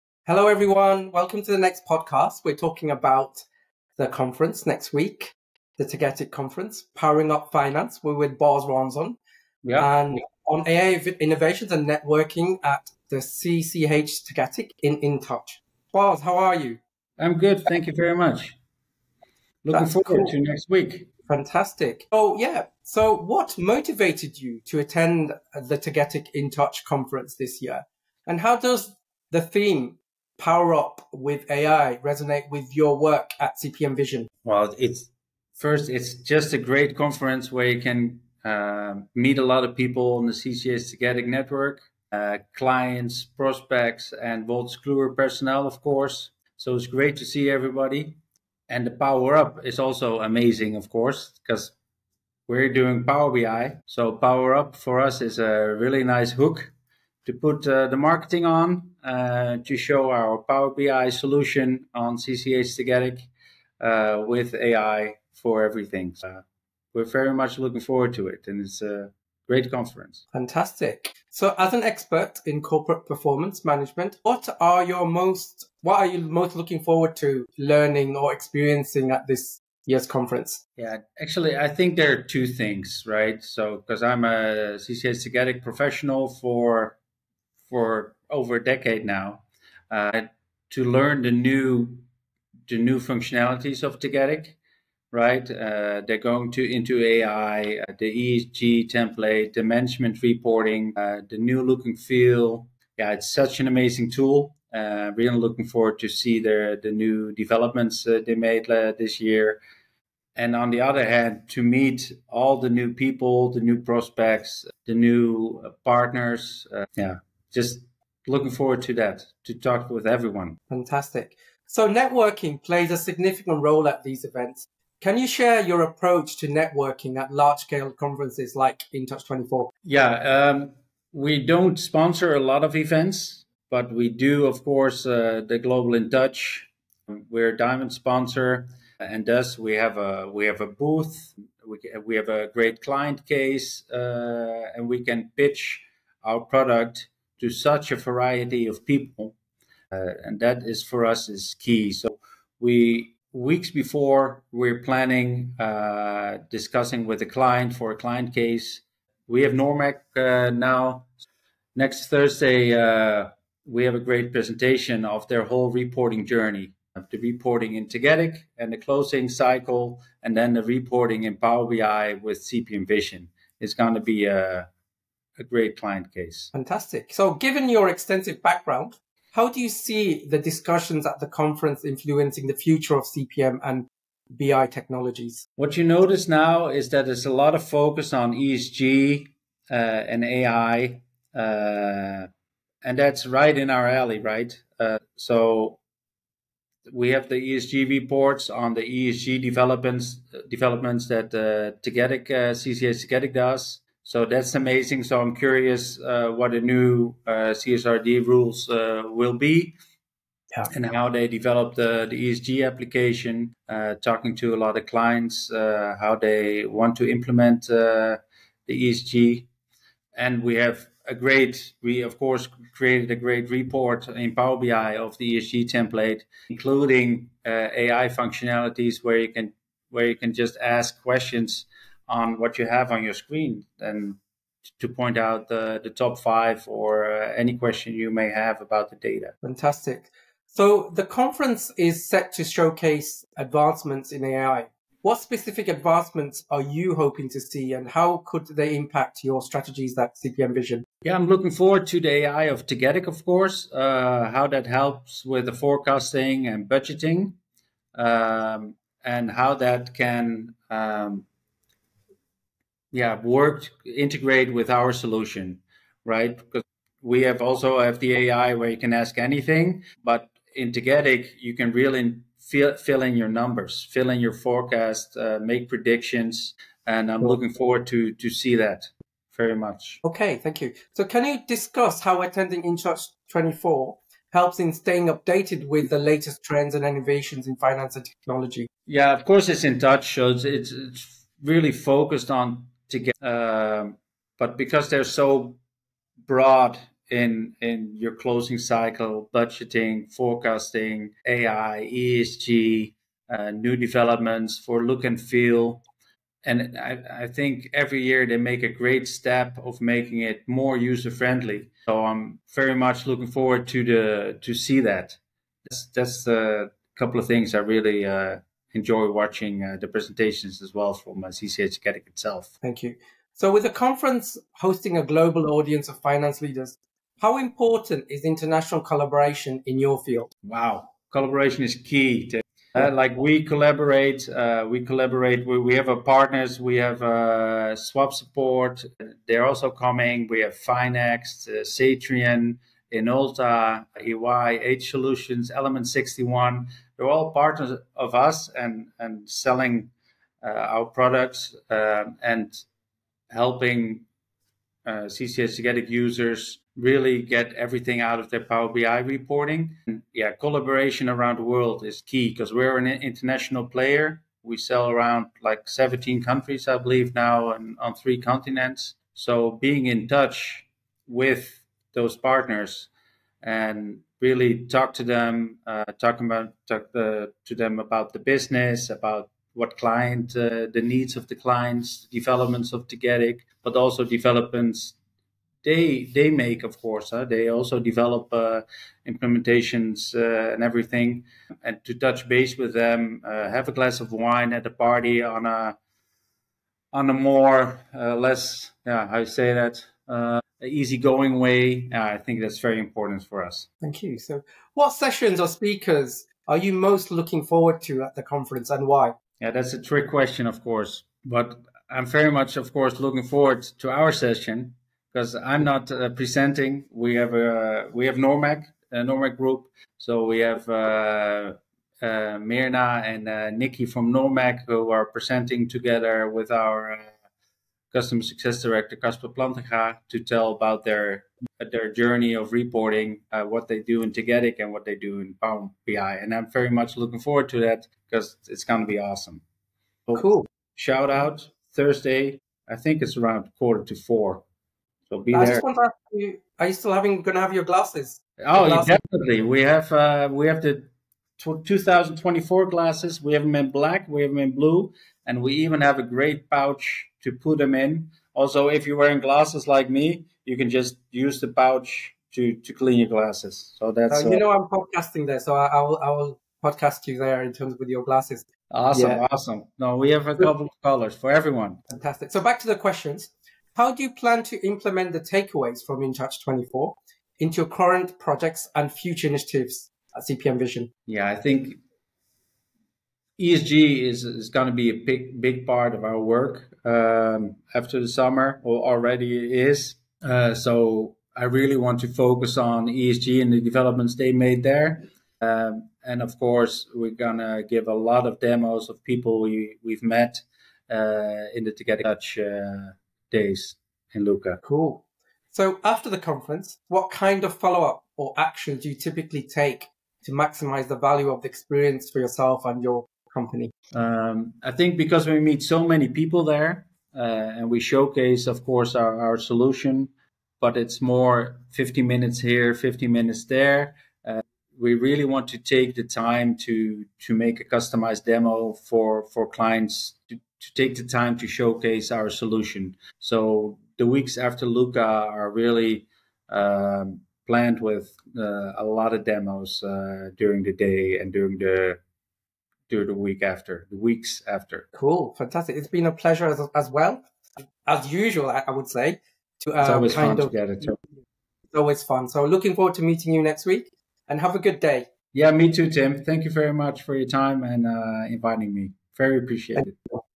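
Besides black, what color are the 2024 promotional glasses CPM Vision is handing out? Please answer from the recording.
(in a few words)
Blue.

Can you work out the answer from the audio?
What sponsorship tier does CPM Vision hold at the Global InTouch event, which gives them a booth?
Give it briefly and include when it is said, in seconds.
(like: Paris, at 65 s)
Diamond, at 137 s.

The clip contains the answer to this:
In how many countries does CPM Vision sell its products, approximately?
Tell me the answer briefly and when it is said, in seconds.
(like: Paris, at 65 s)
17, at 365 s.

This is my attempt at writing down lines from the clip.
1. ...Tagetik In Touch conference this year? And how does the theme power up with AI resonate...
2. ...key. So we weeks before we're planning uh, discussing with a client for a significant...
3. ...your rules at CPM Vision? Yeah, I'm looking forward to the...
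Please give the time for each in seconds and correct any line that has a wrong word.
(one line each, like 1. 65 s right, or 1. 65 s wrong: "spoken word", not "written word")
1. 25 s right
2. 151 s wrong: "client", not "significant"
3. 249 s wrong: "strategies", not "rules".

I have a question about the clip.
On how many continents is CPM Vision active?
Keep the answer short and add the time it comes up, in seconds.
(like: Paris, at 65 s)
Three, at 367 s.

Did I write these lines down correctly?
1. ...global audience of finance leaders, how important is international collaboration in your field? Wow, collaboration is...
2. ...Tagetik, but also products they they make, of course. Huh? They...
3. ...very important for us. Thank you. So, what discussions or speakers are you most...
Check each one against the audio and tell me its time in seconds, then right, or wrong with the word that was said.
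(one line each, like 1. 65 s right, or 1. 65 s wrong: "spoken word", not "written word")
1. 325 s right
2. 382 s wrong: "developments", not "products"
3. 402 s wrong: "sessions", not "discussions".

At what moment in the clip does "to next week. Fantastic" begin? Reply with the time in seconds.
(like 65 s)
20 s.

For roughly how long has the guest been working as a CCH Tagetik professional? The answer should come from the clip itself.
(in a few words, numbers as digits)
Over a decade.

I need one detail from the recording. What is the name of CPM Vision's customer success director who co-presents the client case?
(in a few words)
Casper Plantenga.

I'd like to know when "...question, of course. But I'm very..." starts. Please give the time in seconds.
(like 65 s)
410 s.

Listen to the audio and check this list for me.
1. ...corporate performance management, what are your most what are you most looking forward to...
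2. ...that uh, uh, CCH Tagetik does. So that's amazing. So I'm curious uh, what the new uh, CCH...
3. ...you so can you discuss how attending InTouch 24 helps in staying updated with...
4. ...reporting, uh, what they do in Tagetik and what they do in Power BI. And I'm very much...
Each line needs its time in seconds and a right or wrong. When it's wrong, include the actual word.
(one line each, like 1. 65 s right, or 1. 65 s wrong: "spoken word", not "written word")
1. 72 s right
2. 201 s wrong: "CSRD", not "CCH"
3. 280 s right
4. 432 s right.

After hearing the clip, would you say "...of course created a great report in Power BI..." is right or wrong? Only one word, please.
right.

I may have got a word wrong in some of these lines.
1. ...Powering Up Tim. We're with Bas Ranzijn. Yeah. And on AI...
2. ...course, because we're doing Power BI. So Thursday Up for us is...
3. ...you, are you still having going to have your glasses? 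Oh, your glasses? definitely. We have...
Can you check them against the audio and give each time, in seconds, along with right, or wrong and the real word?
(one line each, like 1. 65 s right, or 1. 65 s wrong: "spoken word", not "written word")
1. 6 s wrong: "Finance", not "Tim"
2. 50 s wrong: "Power", not "Thursday"
3. 446 s right.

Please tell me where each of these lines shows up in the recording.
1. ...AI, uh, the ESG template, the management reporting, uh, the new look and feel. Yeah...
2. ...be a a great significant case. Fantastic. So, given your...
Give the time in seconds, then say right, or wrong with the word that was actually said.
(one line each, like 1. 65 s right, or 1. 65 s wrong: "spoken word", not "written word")
1. 97 s right
2. 174 s wrong: "client", not "significant".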